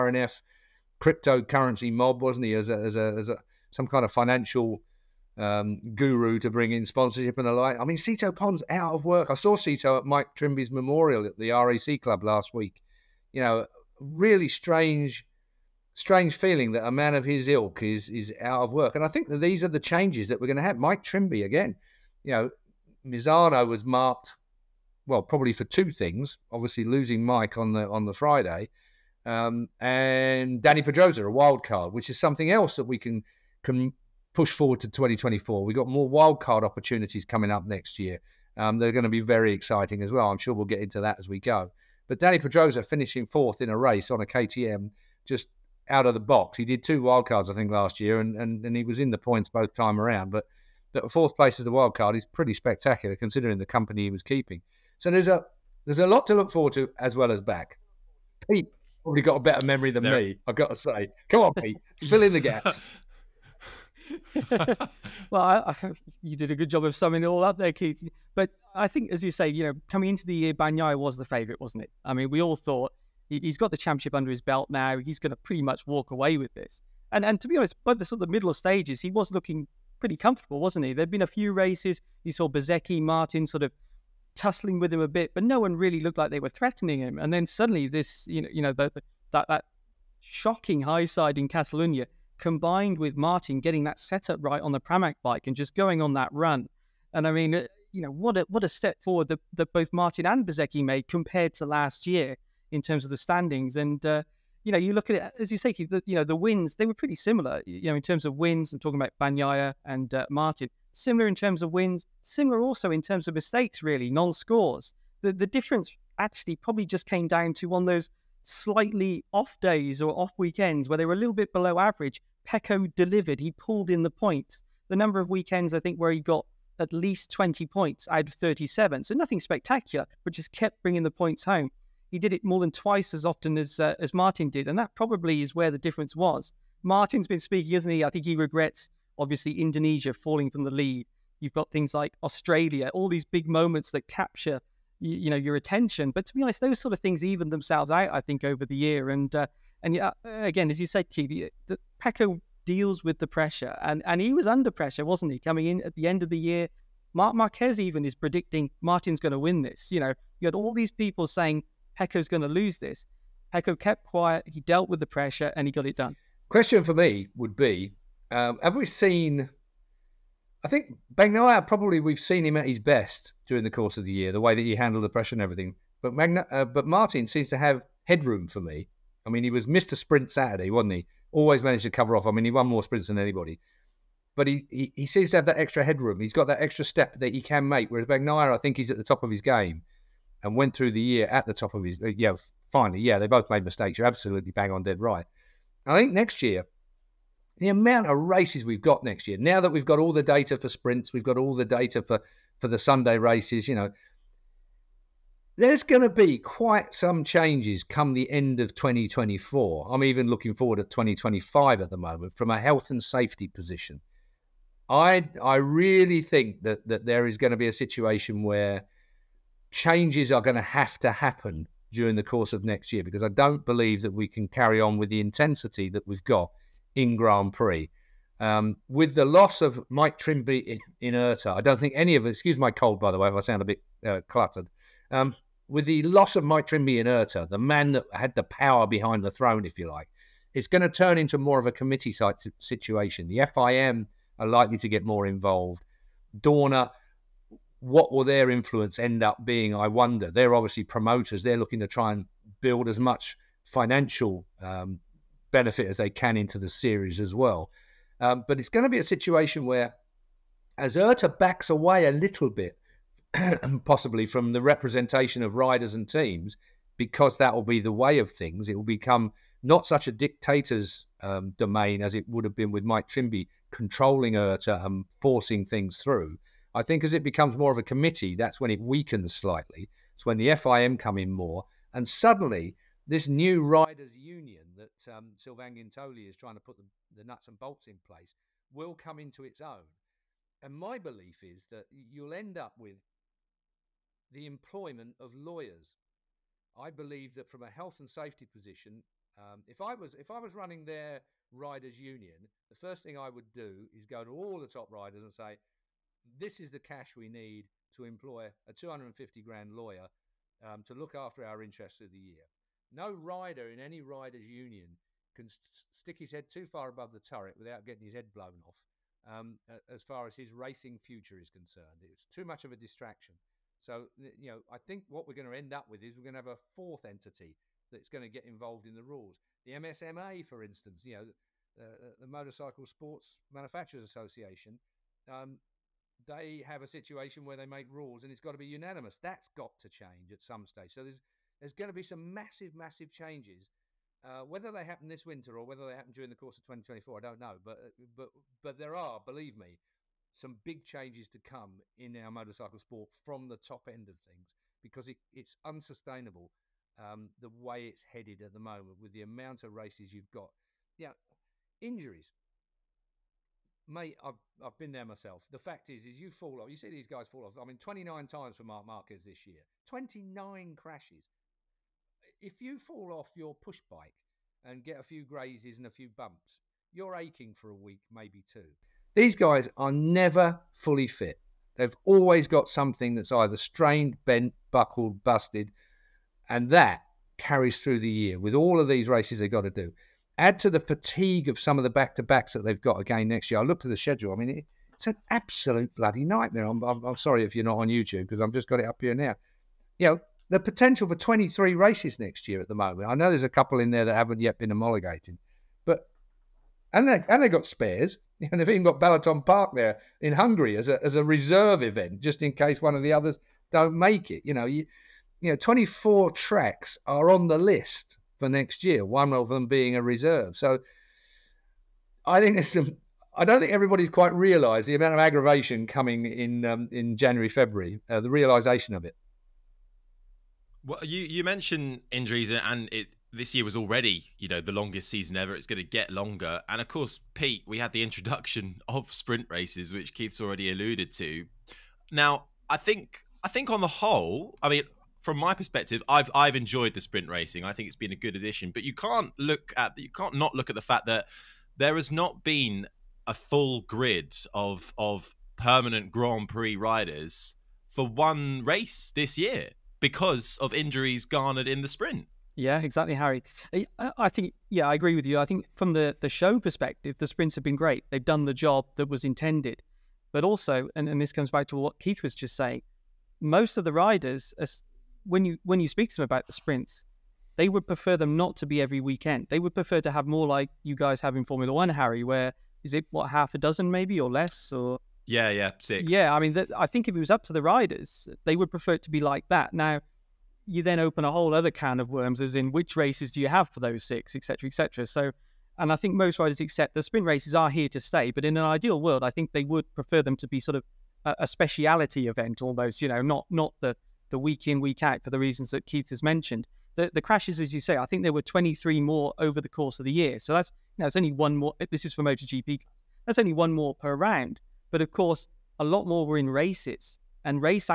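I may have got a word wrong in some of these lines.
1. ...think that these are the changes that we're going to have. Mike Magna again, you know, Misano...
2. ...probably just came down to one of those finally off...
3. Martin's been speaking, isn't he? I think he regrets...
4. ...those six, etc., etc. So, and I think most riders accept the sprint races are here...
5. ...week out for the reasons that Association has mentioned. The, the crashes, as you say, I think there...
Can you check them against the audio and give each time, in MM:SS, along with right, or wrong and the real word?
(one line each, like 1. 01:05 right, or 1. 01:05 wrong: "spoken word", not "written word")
1. 00:19 wrong: "Trimby", not "Magna"
2. 01:56 wrong: "slightly", not "finally"
3. 02:16 right
4. 08:13 right
5. 08:24 wrong: "Keith", not "Association".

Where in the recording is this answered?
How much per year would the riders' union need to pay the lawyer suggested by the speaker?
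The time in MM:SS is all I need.
05:08.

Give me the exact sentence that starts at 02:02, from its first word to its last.
Pecco delivered; he pulled in the points.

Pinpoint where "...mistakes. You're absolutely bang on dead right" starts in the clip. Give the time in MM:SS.
03:13.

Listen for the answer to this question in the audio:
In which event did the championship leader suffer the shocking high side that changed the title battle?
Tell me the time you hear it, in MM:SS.
01:31.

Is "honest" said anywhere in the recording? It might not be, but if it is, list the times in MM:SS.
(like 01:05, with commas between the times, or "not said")
01:17, 02:26.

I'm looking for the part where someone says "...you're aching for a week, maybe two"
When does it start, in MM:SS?
06:16.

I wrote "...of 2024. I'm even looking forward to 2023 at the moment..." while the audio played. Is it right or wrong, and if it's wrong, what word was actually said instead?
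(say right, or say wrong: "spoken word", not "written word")
wrong: "2025", not "2023".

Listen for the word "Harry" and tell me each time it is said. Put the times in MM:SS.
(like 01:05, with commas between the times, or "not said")
07:43, 08:01.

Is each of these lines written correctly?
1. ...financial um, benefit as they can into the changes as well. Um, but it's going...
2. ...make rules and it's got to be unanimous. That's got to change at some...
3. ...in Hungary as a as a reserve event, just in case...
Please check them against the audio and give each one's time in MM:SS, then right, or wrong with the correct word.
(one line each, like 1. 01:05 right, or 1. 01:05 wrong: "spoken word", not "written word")
1. 04:13 wrong: "series", not "changes"
2. 05:37 right
3. 06:50 right.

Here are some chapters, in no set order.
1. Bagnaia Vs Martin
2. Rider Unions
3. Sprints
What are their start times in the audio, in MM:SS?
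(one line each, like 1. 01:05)
1. 02:55
2. 04:55
3. 07:45.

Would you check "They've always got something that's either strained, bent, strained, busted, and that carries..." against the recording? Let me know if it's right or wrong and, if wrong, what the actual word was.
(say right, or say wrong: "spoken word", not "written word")
wrong: "buckled", not "strained".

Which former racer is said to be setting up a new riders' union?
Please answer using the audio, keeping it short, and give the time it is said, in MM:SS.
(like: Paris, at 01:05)
Sylvain Guintoli, at 04:45.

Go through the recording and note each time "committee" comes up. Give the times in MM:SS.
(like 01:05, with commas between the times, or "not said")
04:01, 04:37.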